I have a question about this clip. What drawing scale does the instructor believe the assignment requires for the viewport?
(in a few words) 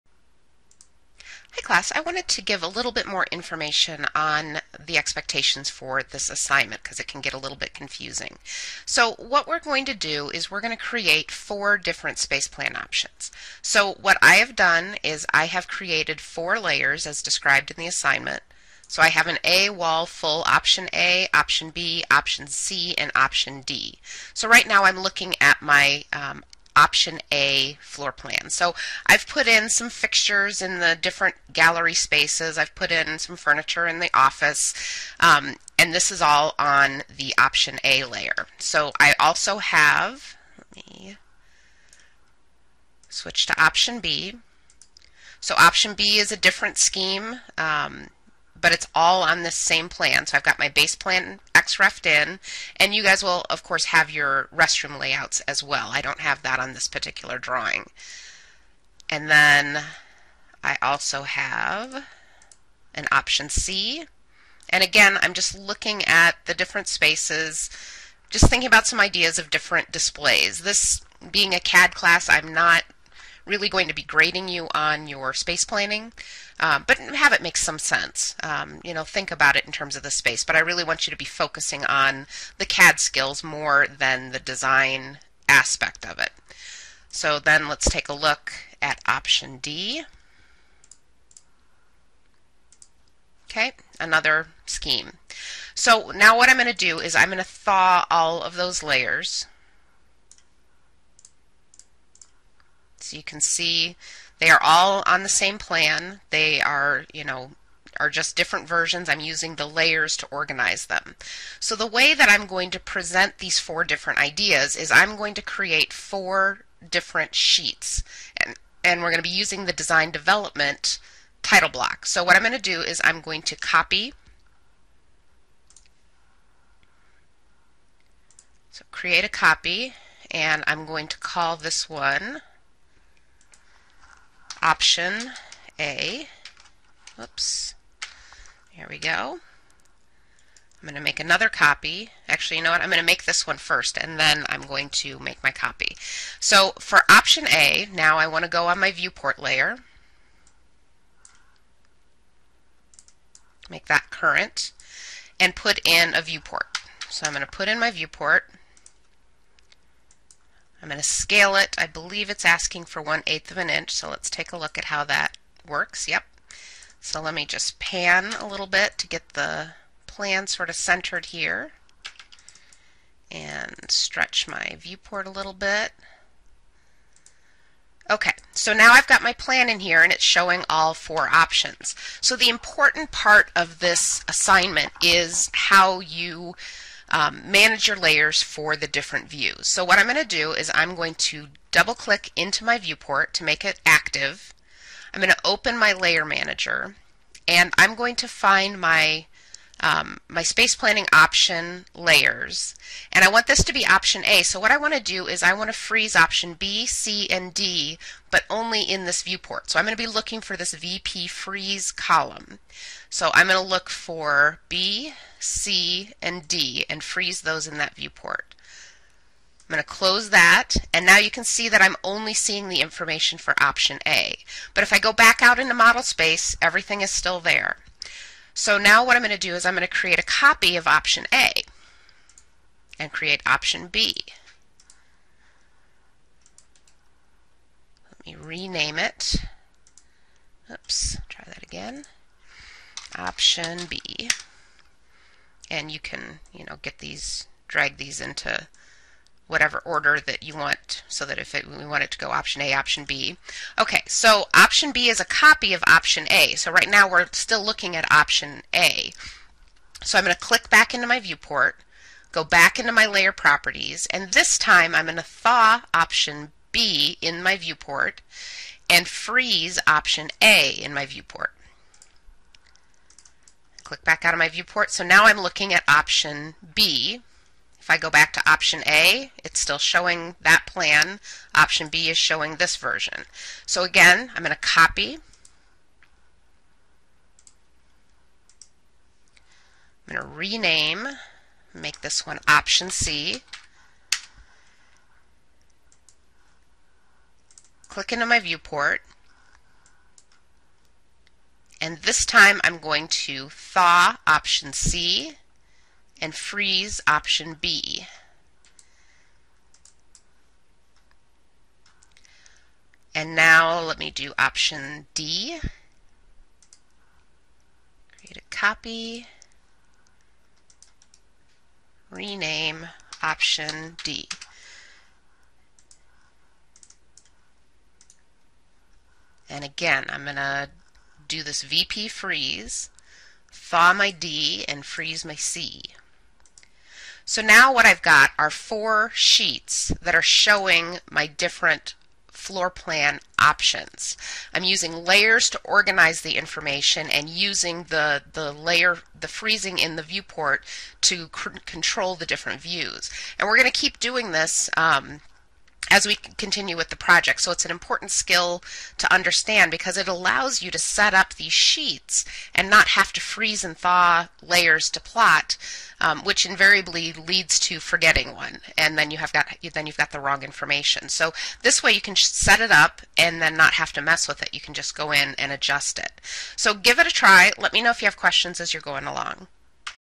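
1/8 inch.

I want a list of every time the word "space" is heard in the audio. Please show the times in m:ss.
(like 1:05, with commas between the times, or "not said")
0:12, 0:31, 1:06, 1:15, 1:20, 3:20, 3:46.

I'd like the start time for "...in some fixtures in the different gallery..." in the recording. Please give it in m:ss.
0:29.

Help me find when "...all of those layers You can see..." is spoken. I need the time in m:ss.
1:38.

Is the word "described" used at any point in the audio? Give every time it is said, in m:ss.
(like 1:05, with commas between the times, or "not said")
0:17.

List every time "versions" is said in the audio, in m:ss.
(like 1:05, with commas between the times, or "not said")
1:48, 4:42.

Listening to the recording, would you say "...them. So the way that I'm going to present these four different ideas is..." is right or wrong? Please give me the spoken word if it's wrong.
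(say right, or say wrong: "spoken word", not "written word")
right.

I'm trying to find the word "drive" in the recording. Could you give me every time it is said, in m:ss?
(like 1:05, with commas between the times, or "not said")
not said.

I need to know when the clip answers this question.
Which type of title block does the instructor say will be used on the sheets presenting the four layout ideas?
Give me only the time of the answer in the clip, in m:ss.
1:59.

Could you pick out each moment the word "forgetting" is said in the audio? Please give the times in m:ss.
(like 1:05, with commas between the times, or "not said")
6:07.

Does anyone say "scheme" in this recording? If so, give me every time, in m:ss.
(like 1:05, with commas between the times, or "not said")
0:46, 1:34.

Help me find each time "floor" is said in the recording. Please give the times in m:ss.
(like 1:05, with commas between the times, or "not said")
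0:27, 5:42.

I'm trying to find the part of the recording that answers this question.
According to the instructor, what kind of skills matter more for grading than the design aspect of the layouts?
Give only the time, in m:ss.
1:22.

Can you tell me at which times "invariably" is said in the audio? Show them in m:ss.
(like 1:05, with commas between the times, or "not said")
6:06.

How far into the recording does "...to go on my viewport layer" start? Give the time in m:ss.
2:28.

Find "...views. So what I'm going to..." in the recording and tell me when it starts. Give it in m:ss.
3:09.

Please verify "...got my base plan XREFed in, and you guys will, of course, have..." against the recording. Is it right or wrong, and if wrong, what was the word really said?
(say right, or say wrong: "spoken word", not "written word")
right.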